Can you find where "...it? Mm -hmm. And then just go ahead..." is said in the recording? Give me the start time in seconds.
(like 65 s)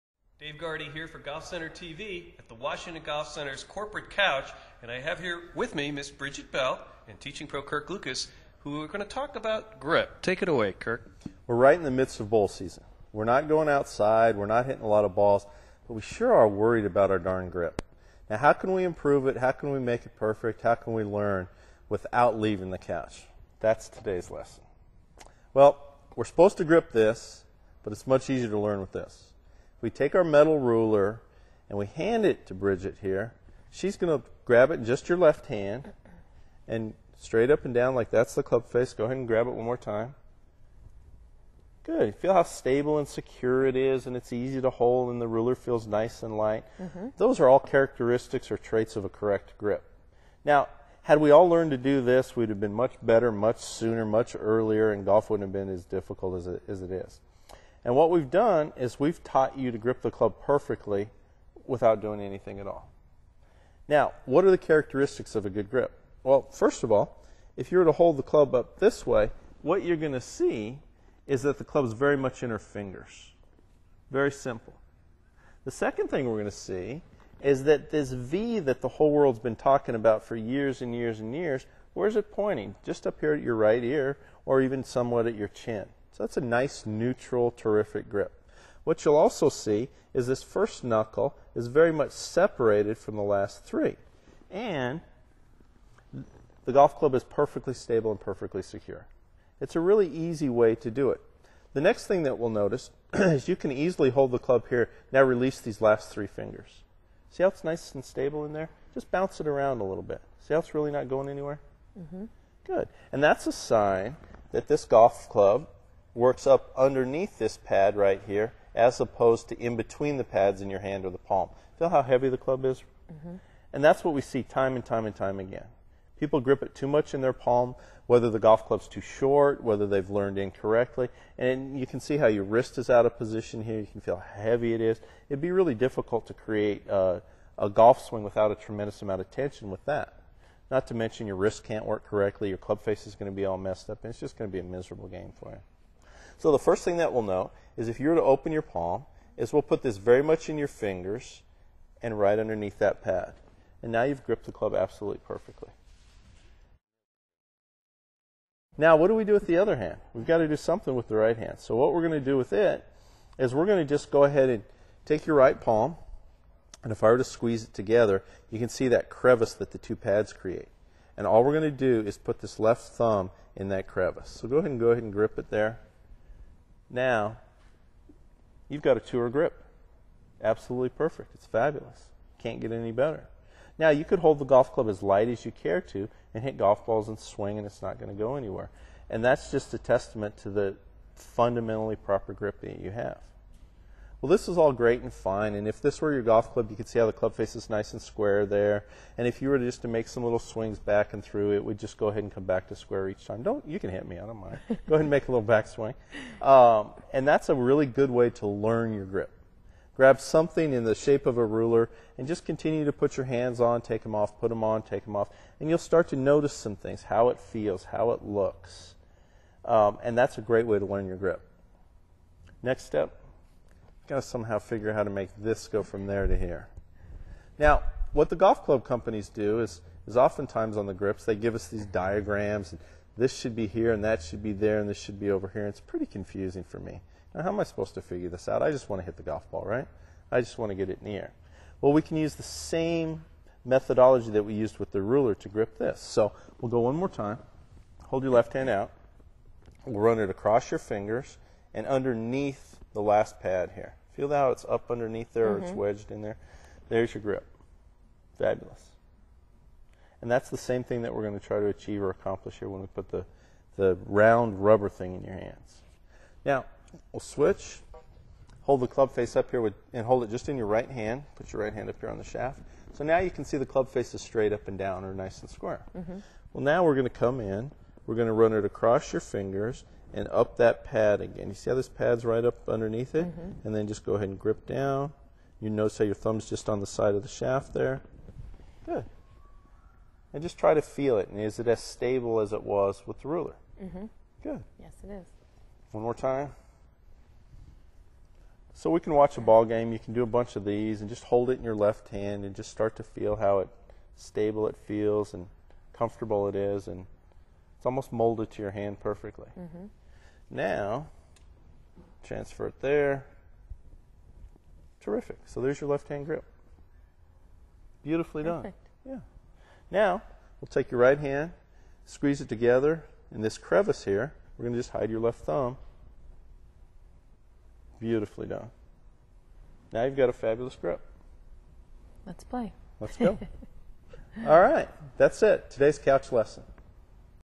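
283 s.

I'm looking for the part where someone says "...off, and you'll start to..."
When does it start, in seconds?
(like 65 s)
215 s.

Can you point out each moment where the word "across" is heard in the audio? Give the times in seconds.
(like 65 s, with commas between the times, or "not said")
250 s, 278 s.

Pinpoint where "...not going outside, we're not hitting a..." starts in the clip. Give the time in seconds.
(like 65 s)
13 s.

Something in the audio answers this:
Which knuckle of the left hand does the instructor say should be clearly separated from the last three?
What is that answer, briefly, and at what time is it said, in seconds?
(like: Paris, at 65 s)
first knuckle, at 90 s.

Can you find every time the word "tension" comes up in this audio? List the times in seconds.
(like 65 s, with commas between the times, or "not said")
139 s.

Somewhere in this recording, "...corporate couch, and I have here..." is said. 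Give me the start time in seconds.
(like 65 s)
3 s.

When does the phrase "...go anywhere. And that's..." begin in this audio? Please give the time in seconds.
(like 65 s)
188 s.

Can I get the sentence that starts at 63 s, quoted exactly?
Now, what are the characteristics of a good grip?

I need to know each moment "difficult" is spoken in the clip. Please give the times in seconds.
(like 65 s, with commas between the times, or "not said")
55 s, 135 s.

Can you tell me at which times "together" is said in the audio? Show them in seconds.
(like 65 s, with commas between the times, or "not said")
167 s, 322 s.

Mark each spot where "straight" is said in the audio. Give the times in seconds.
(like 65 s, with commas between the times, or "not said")
37 s, 274 s.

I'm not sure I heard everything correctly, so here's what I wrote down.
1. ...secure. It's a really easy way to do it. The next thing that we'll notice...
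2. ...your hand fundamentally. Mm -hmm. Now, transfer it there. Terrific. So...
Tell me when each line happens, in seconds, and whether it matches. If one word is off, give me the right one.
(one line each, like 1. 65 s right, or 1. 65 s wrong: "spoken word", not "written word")
1. 98 s right
2. 308 s wrong: "perfectly", not "fundamentally".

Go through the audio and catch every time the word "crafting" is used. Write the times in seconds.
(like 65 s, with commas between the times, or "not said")
not said.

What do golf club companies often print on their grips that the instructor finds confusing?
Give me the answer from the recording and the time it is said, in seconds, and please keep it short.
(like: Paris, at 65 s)
diagrams, at 231 s.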